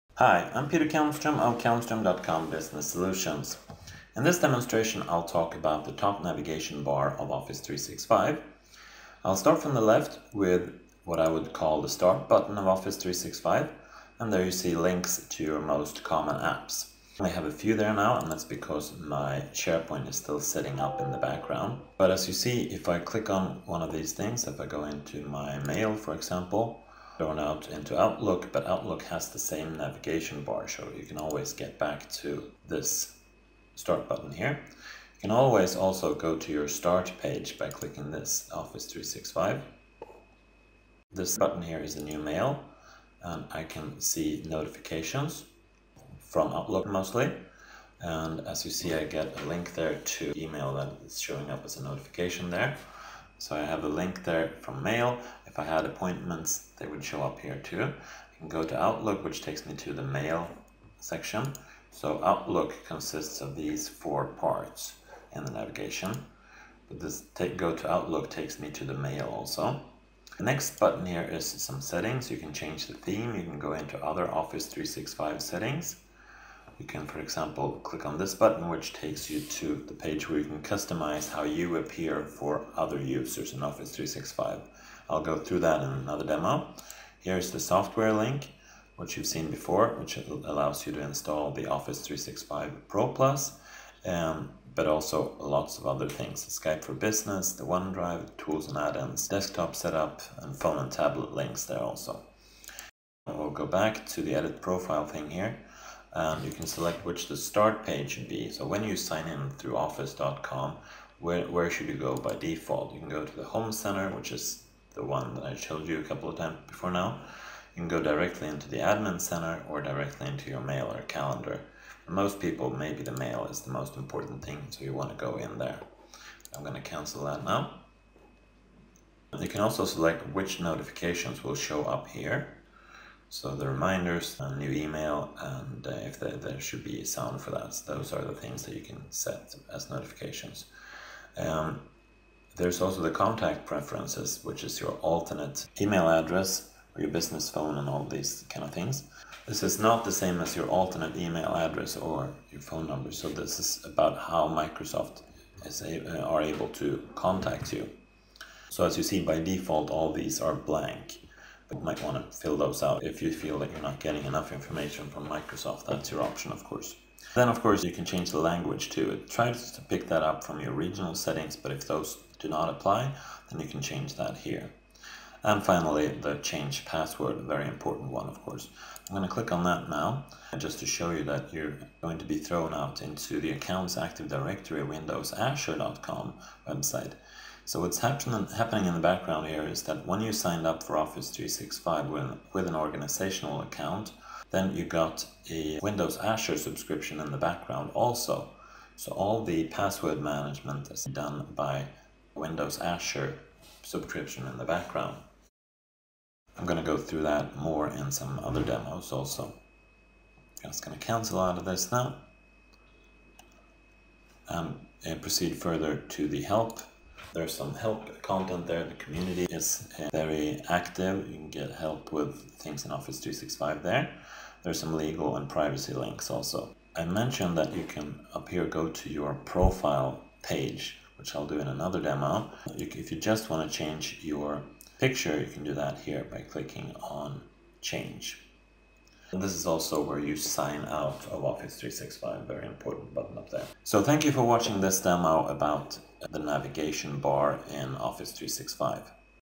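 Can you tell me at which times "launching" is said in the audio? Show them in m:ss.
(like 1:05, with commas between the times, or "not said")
not said.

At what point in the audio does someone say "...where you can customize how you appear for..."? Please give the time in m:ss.
1:20.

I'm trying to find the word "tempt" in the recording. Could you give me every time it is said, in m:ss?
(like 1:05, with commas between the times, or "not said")
not said.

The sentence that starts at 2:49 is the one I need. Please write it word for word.
Try to pick that up from your regional settings, but if those do not apply, then you can change that here.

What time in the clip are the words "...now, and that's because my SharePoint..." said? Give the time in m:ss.
0:17.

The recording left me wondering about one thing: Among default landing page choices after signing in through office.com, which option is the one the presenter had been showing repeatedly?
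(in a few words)
home center.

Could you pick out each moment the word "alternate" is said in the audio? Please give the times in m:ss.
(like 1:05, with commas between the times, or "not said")
2:25, 2:30.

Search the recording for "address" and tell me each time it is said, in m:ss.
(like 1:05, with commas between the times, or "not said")
2:26, 2:31.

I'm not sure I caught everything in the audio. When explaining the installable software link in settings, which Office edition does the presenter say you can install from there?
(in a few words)
Office 365 Pro Plus.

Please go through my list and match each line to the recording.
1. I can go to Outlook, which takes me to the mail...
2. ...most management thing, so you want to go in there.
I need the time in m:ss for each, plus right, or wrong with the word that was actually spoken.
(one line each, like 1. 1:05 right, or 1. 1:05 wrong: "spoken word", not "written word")
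1. 0:57 right
2. 2:03 wrong: "important", not "management".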